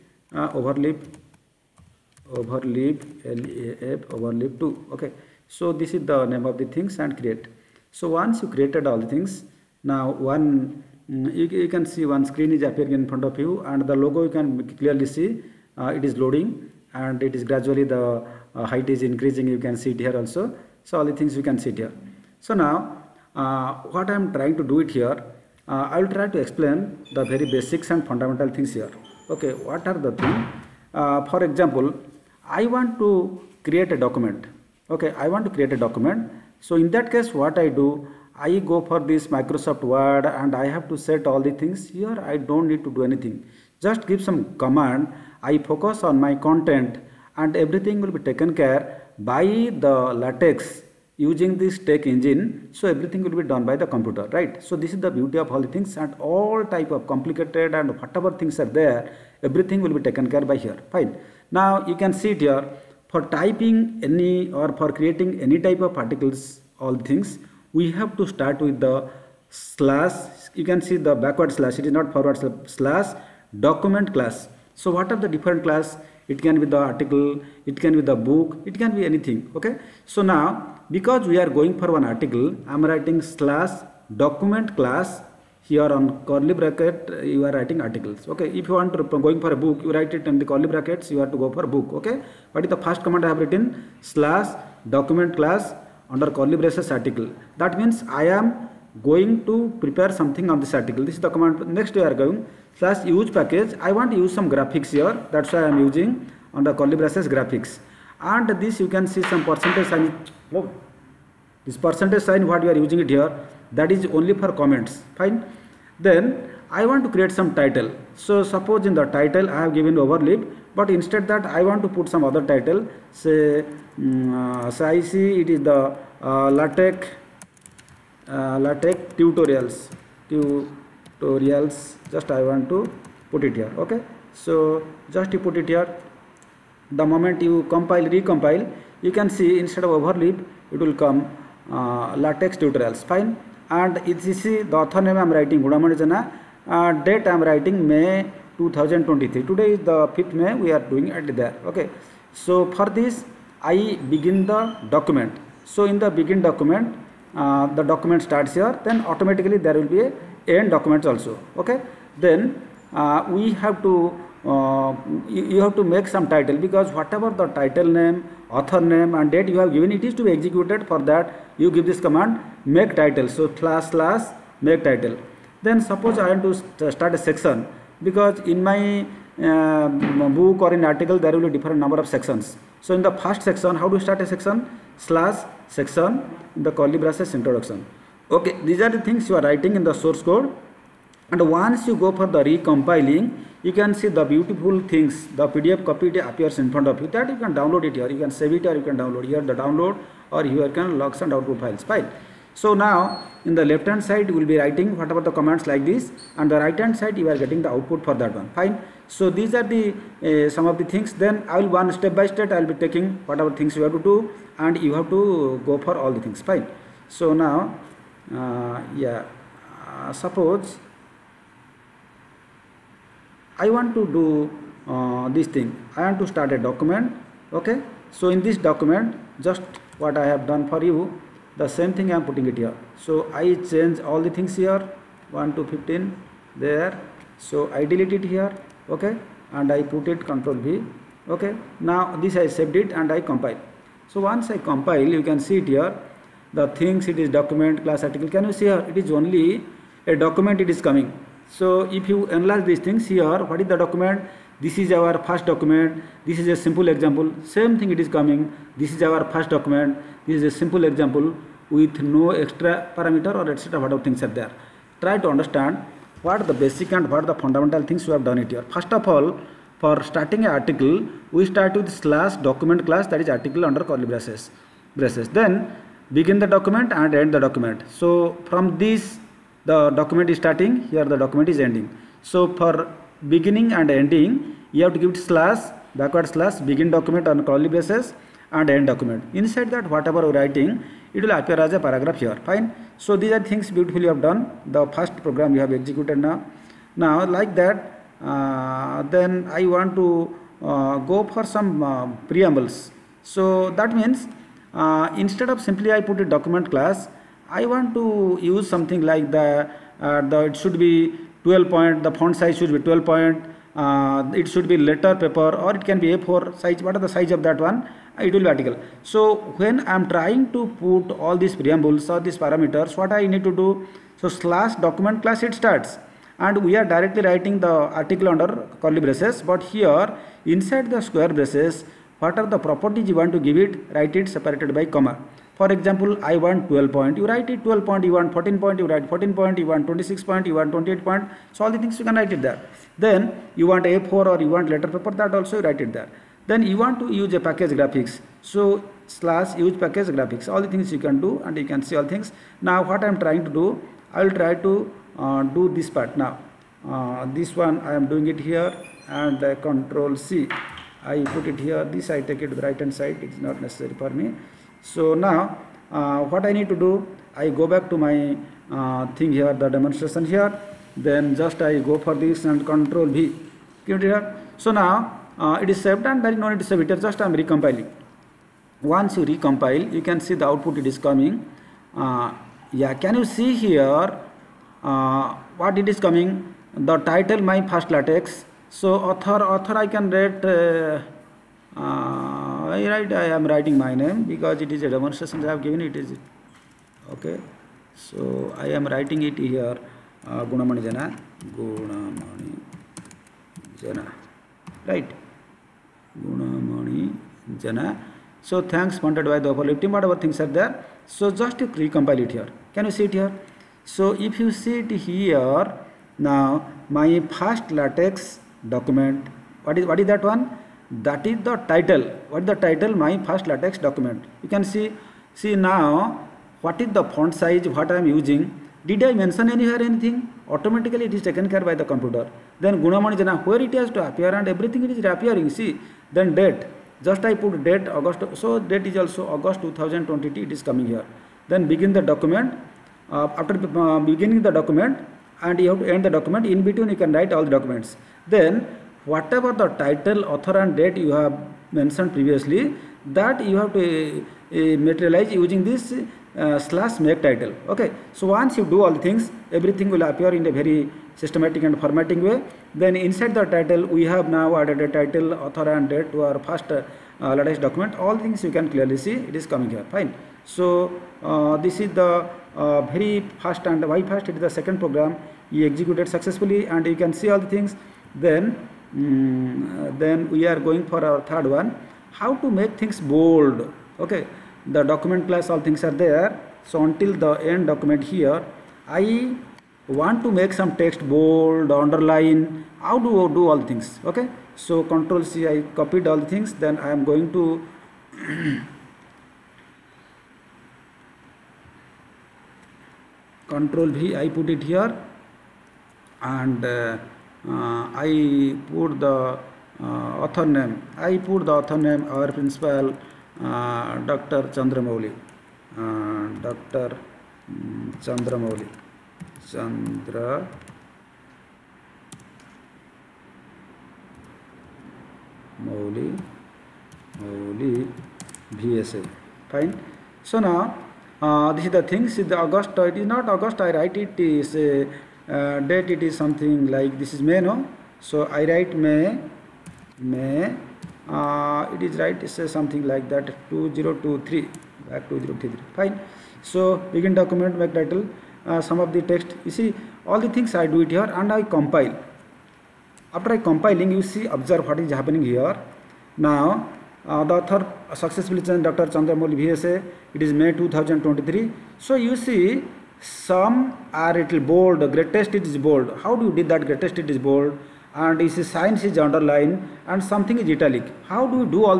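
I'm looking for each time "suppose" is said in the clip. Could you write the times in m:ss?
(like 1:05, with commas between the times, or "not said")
1:58, 2:55, 3:40.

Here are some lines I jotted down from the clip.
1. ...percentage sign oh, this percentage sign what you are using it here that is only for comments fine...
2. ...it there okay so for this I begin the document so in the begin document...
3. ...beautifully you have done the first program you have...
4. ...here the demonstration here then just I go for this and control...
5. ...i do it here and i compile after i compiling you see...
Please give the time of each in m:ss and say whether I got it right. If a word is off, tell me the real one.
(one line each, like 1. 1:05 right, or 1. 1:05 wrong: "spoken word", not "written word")
1. 1:49 right
2. 2:31 right
3. 4:53 right
4. 6:09 right
5. 9:10 right.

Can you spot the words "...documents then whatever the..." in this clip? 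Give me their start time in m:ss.
7:27.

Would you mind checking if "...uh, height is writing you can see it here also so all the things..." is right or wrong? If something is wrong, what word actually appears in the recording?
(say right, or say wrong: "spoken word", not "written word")
wrong: "increasing", not "writing".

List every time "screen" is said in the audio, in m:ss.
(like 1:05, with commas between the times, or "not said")
0:12.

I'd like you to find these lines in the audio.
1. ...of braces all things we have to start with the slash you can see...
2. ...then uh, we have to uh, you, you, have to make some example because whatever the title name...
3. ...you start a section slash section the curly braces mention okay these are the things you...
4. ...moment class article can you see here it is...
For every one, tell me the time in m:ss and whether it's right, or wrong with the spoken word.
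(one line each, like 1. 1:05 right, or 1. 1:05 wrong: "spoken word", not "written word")
1. 1:05 wrong: "articles", not "braces"
2. 2:42 wrong: "title", not "example"
3. 3:03 wrong: "introduction", not "mention"
4. 4:07 wrong: "document", not "moment".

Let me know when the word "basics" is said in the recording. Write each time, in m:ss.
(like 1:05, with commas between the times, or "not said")
0:27, 4:26.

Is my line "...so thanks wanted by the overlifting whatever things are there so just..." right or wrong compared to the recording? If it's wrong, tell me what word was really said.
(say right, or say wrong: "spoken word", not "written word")
right.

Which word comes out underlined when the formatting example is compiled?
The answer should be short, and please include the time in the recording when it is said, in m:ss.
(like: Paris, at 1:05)
science, at 9:28.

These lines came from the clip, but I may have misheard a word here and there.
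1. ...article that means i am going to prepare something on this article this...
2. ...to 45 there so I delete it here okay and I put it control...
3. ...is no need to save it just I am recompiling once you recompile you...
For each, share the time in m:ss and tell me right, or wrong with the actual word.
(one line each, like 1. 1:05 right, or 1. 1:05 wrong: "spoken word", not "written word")
1. 1:36 right
2. 3:55 wrong: "15", not "45"
3. 6:16 right.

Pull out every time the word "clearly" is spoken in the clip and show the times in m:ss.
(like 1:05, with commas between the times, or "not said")
0:14, 7:48.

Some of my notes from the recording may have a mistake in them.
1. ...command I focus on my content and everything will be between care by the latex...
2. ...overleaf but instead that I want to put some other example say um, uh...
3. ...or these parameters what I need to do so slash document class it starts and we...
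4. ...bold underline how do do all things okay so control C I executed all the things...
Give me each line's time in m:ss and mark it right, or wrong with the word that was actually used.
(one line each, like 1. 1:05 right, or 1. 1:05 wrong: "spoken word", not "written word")
1. 0:44 wrong: "taken", not "between"
2. 1:59 wrong: "title", not "example"
3. 5:22 right
4. 8:11 wrong: "copied", not "executed".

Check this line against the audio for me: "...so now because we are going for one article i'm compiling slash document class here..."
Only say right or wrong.
wrong.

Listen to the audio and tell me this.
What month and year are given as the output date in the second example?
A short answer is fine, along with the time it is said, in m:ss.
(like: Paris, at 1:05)
August 2022, at 7:19.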